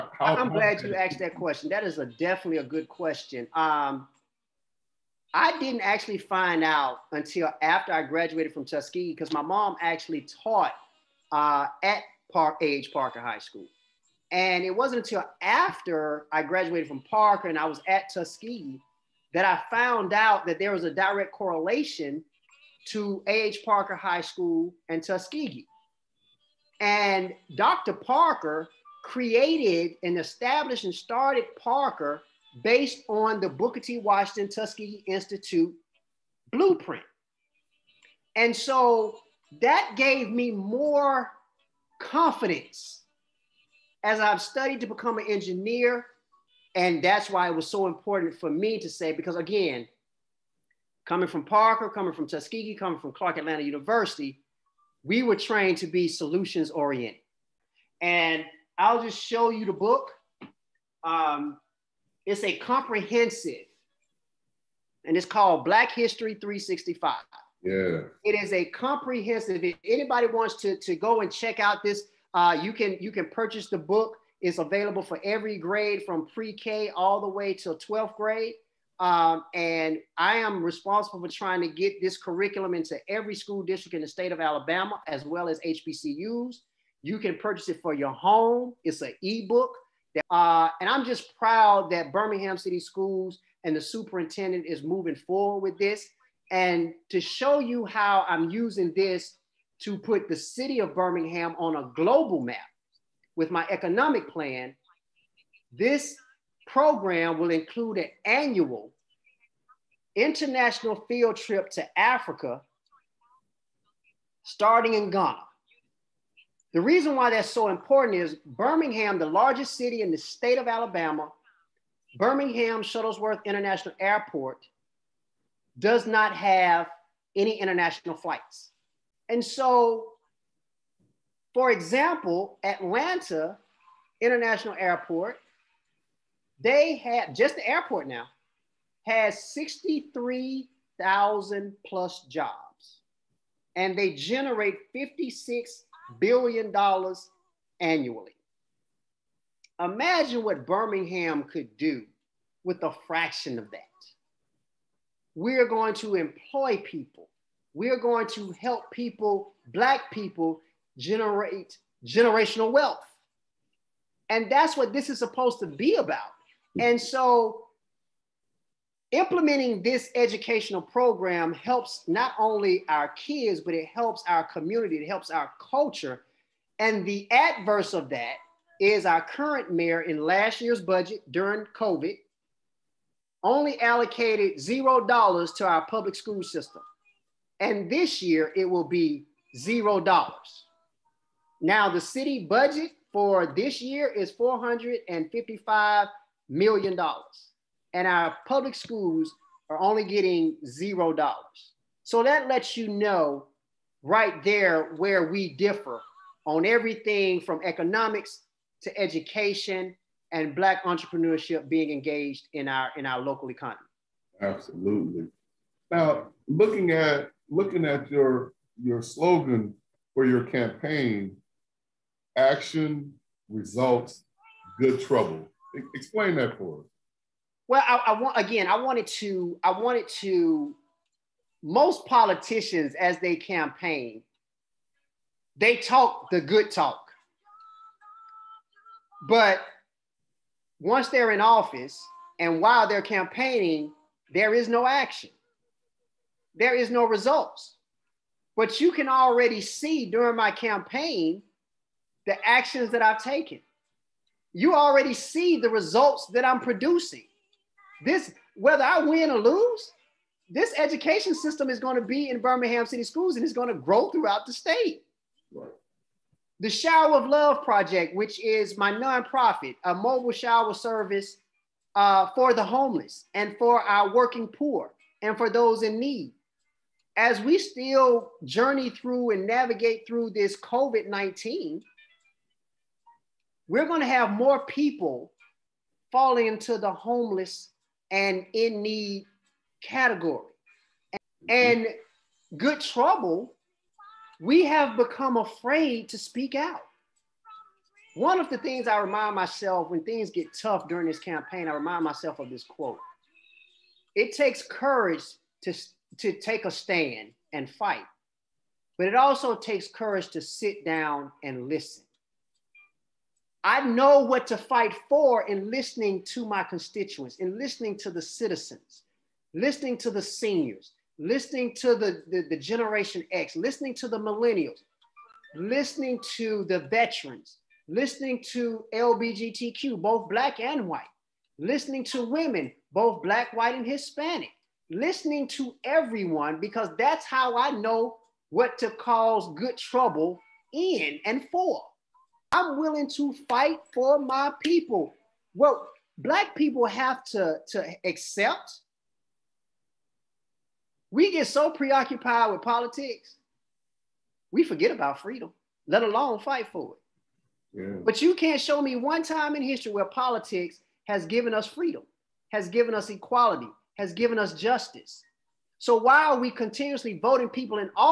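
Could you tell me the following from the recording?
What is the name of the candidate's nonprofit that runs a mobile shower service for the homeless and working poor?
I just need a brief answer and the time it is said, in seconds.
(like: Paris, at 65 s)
The Shower of Love Project, at 266 s.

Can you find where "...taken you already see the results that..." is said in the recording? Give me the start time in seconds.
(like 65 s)
253 s.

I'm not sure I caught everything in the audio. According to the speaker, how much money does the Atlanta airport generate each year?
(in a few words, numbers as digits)
56 billion dollars.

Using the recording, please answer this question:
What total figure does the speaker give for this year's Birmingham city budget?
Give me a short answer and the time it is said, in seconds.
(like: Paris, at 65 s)
455 million dollars, at 194 s.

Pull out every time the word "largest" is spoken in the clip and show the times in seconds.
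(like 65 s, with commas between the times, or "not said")
119 s.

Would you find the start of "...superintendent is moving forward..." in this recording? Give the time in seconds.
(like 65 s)
93 s.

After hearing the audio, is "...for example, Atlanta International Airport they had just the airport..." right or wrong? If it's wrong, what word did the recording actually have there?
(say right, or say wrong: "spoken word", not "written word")
right.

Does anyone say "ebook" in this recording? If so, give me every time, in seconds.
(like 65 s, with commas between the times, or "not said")
89 s.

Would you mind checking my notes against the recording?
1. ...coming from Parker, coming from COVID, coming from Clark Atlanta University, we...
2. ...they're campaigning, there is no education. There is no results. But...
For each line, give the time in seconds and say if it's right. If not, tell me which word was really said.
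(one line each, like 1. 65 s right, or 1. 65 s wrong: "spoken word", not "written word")
1. 51 s wrong: "Tuskegee", not "COVID"
2. 242 s wrong: "action", not "education".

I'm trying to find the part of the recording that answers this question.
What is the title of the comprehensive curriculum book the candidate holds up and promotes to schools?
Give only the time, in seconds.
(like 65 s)
65 s.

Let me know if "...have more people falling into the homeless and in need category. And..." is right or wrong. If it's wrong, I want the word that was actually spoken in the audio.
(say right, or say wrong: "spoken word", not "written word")
right.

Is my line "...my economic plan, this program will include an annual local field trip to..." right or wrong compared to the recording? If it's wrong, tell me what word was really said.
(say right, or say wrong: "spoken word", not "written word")
wrong: "international", not "local".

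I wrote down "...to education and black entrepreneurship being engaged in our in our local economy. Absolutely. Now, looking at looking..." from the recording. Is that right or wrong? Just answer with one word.
right.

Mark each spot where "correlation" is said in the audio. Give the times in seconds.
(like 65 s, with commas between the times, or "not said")
21 s.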